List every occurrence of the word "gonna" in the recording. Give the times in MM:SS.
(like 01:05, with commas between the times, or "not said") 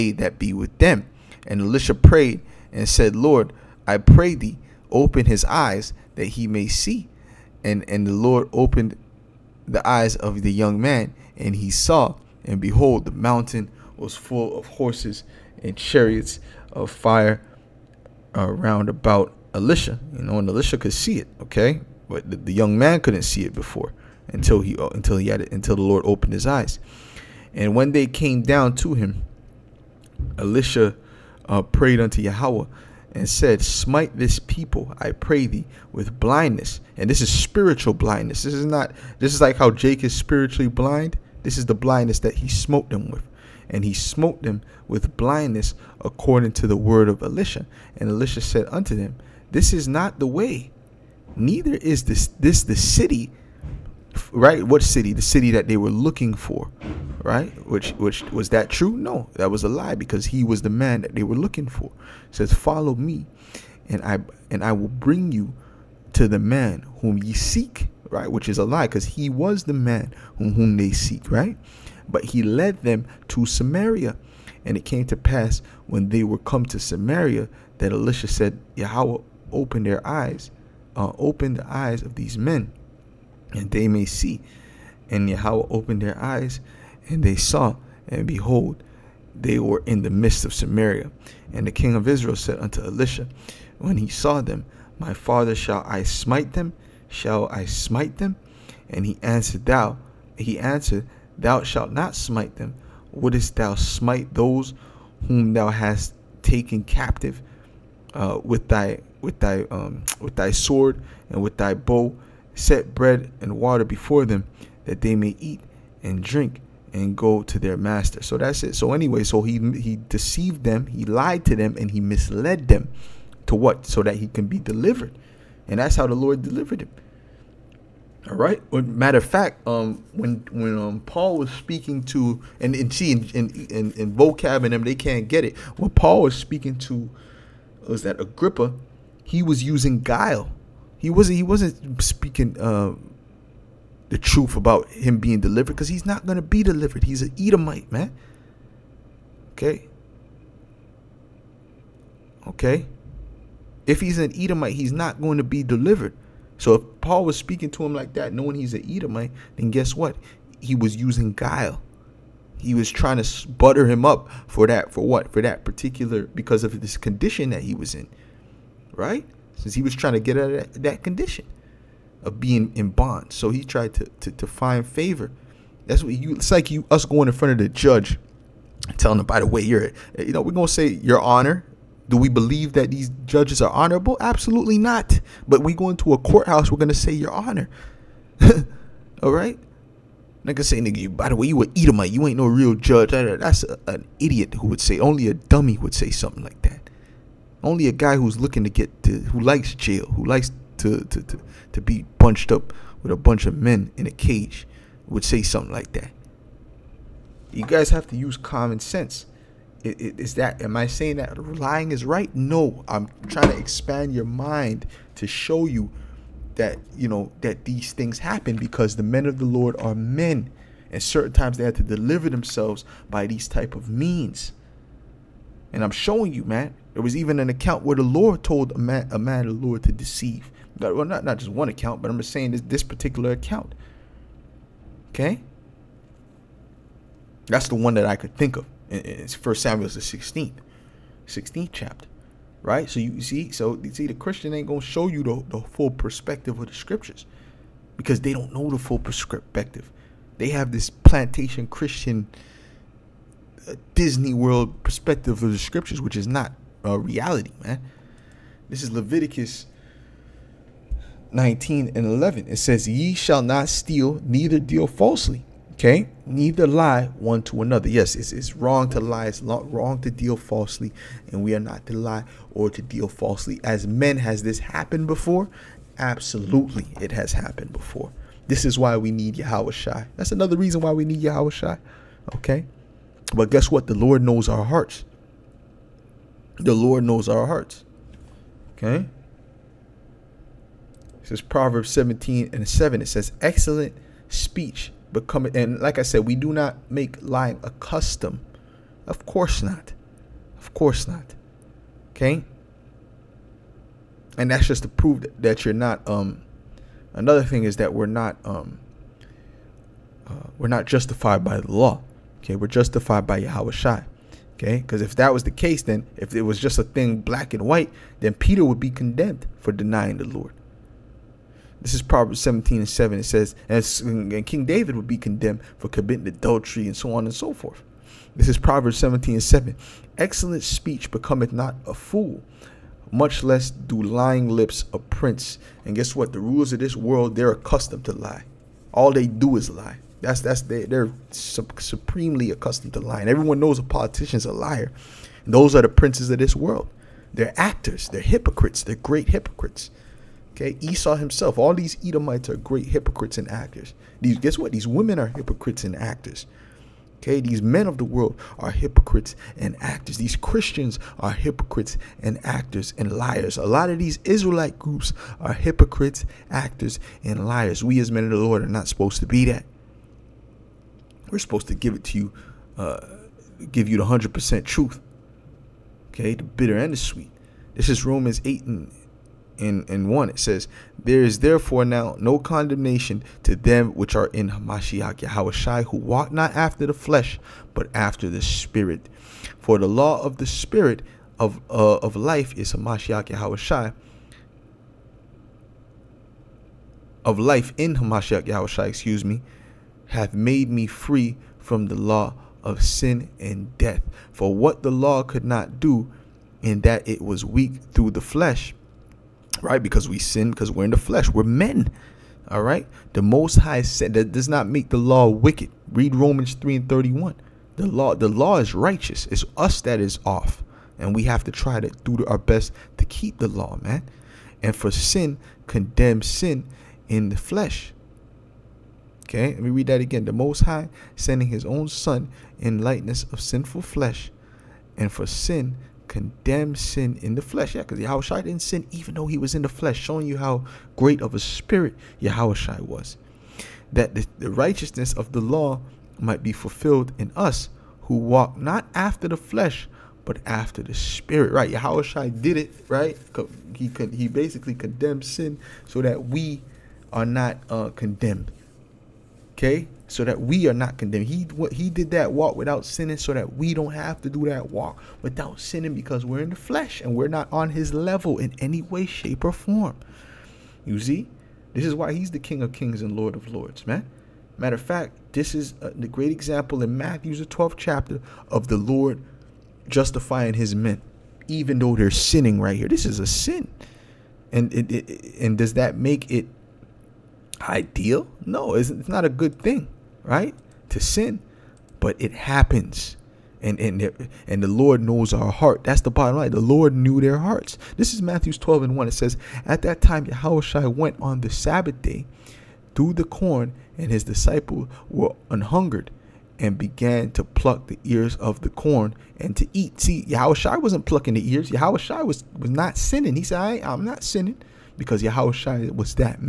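02:26, 03:00, 03:06, 04:04.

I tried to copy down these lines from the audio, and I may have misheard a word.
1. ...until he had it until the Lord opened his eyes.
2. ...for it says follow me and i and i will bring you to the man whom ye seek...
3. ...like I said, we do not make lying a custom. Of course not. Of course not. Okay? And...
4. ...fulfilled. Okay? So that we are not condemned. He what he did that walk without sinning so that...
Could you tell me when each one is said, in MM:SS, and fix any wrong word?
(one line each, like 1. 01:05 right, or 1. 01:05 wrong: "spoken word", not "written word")
1. 00:24 right
2. 01:01 right
3. 04:55 right
4. 07:37 wrong: "condemned", not "fulfilled".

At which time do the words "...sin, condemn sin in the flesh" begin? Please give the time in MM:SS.
07:04.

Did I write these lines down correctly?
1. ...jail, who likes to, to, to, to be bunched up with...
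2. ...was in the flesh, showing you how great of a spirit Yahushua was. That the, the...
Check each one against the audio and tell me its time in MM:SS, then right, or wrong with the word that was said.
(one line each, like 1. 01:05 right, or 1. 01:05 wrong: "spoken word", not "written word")
1. 03:19 right
2. 07:19 right.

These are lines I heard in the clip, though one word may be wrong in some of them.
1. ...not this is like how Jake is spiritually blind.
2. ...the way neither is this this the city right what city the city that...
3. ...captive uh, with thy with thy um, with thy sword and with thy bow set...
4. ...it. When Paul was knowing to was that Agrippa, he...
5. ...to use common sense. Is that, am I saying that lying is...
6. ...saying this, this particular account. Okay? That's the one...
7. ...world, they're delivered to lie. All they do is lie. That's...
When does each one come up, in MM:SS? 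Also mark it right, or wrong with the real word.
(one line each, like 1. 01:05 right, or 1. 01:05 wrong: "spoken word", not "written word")
1. 00:38 right
2. 00:50 right
3. 01:46 right
4. 02:15 wrong: "speaking", not "knowing"
5. 03:28 right
6. 03:52 right
7. 05:36 wrong: "accustomed", not "delivered".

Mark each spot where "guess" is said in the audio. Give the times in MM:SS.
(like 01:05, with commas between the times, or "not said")
02:39, 04:43, 05:35, 05:54.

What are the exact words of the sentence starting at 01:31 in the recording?
And the king of Israel said unto Elisha, When he saw them, My father, shall I smite them?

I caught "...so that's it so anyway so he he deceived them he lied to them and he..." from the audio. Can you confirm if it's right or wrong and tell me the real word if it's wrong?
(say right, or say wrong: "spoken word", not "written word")
right.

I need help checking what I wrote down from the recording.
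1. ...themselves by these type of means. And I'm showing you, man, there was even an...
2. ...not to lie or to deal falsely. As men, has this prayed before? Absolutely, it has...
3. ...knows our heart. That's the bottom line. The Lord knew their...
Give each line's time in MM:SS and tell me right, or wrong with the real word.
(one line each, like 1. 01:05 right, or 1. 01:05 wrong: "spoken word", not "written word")
1. 03:42 right
2. 04:31 wrong: "happened", not "prayed"
3. 08:15 right.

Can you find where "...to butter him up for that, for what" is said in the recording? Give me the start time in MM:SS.
02:43.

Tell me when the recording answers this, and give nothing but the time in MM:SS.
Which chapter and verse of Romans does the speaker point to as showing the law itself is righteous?
06:56.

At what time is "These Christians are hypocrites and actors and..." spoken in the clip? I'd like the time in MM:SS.
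06:00.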